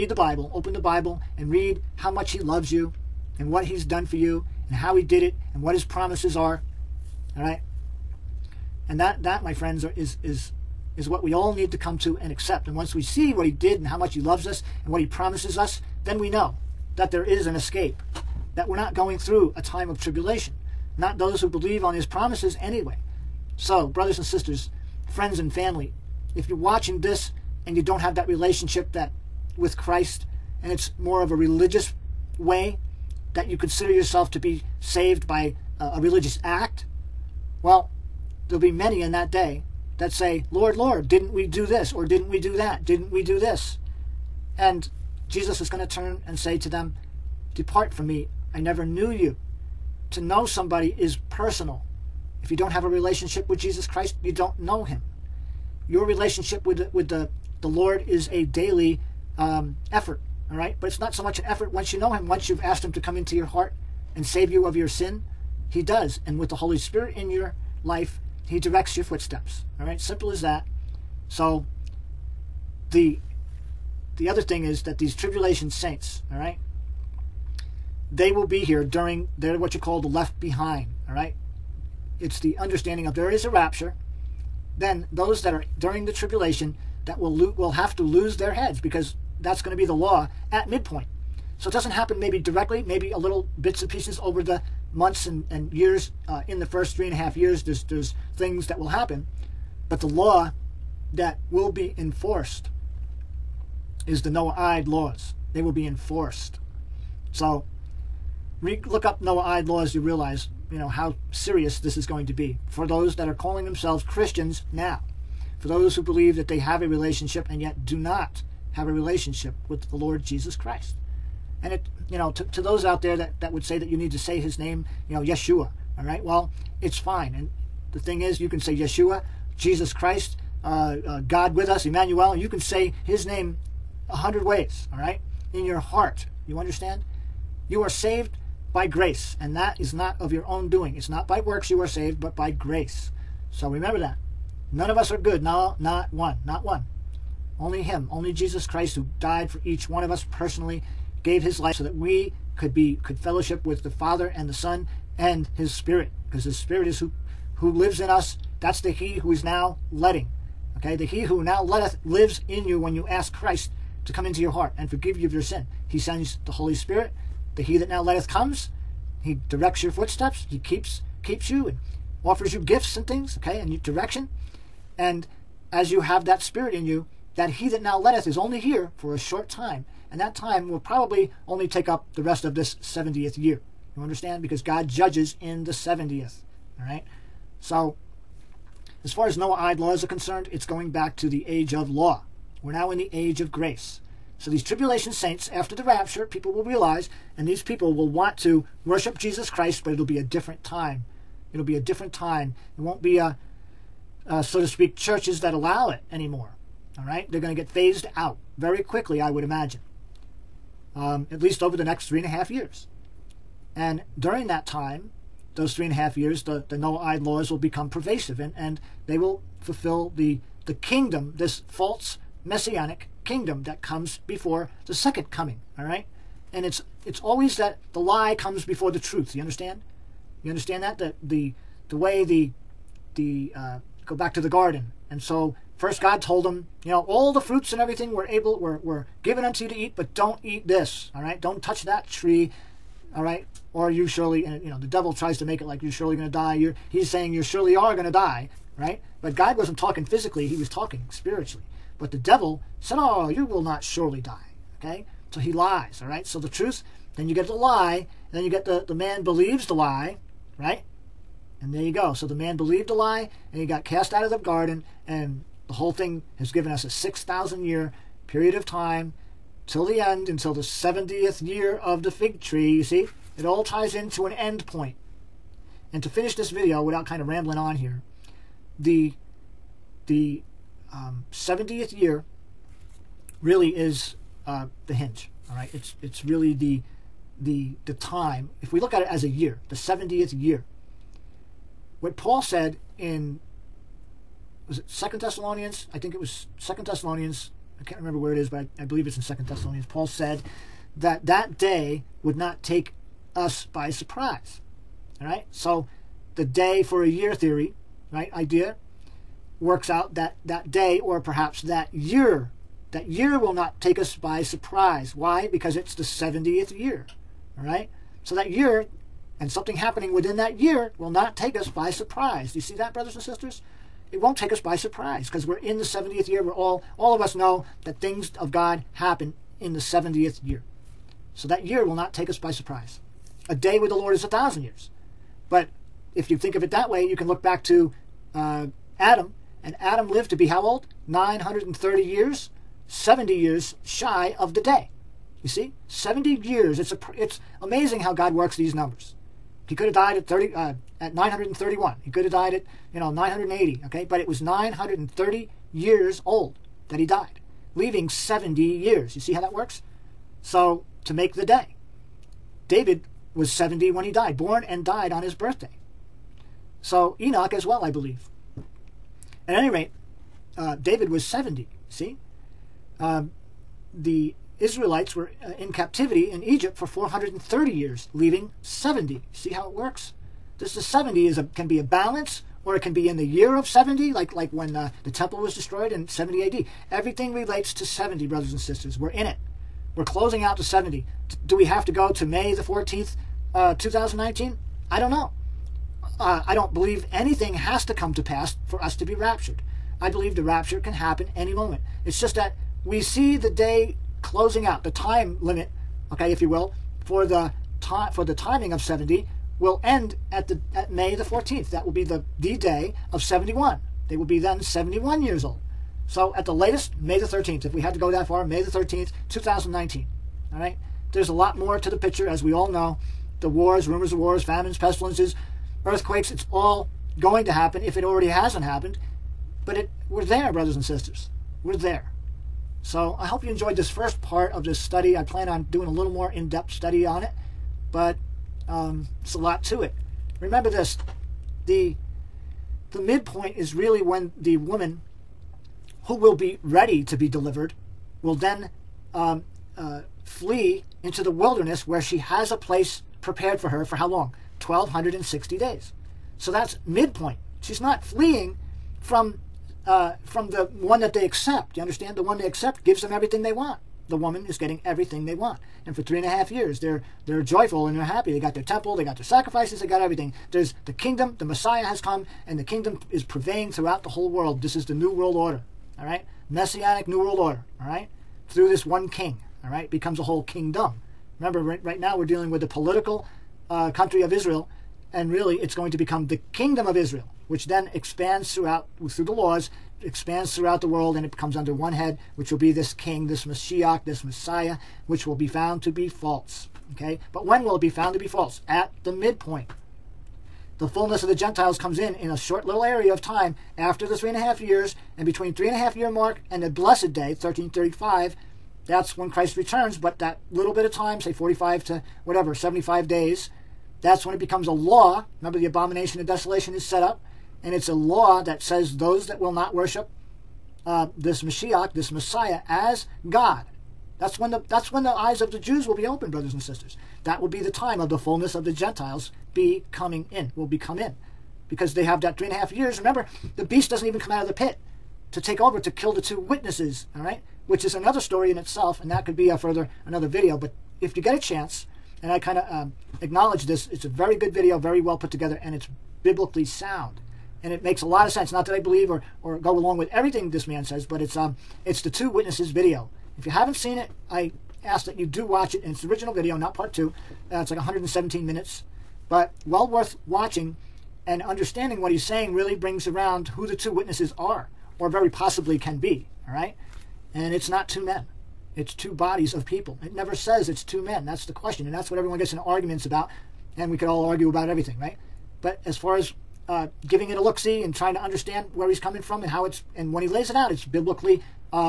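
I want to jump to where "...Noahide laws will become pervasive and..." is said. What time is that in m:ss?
3:36.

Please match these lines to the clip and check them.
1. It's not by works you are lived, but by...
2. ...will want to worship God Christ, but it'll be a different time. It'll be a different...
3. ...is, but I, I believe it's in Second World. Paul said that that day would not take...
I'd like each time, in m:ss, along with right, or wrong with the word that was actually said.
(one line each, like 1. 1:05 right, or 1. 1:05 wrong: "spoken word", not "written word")
1. 2:20 wrong: "saved", not "lived"
2. 3:17 wrong: "Jesus", not "God"
3. 4:58 wrong: "Thessalonians", not "World".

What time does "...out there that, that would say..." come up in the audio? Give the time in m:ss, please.
2:02.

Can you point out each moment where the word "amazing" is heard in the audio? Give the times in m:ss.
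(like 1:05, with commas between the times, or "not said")
5:47.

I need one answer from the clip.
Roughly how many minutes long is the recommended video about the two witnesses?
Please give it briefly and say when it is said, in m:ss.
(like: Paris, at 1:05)
117, at 9:17.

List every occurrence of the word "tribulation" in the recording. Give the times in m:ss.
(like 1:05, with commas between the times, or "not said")
0:19, 1:15, 1:26, 3:14.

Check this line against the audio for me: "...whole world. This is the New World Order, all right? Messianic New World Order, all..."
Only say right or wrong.
right.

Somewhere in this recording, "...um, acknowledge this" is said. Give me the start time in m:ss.
9:02.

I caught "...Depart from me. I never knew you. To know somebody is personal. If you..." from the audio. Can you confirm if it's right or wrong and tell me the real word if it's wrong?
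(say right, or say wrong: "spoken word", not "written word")
right.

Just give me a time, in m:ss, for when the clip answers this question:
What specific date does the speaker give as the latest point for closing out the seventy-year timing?
6:58.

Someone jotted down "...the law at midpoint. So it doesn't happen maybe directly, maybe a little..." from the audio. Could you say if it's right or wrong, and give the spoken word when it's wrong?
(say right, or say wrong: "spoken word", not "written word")
right.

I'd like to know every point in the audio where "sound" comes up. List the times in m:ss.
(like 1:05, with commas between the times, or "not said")
9:06.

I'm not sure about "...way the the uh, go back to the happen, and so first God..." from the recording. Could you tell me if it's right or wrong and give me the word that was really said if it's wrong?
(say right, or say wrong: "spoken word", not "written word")
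wrong: "garden", not "happen".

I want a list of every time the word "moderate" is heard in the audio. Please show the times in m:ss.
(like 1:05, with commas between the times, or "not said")
not said.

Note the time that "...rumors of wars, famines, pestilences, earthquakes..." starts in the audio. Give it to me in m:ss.
7:03.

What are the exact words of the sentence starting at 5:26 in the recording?
We're all, all of us know that things of God happen in the 70th year.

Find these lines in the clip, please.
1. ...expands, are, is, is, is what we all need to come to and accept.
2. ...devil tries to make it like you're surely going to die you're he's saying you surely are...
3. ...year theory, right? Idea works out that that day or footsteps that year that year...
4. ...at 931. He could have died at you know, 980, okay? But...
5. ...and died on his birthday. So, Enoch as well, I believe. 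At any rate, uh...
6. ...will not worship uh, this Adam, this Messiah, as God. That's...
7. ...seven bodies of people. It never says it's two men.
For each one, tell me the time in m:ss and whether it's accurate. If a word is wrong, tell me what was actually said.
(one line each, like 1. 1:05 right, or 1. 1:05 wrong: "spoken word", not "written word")
1. 0:09 wrong: "friends", not "expands"
2. 4:04 right
3. 5:07 wrong: "perhaps", not "footsteps"
4. 5:50 right
5. 6:04 right
6. 8:39 wrong: "Mashiach", not "Adam"
7. 9:28 wrong: "two", not "seven".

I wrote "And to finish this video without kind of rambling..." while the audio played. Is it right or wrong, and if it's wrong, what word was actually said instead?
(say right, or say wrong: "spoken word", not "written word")
right.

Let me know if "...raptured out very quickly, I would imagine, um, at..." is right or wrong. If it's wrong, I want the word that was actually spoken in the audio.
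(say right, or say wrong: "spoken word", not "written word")
wrong: "phased", not "raptured".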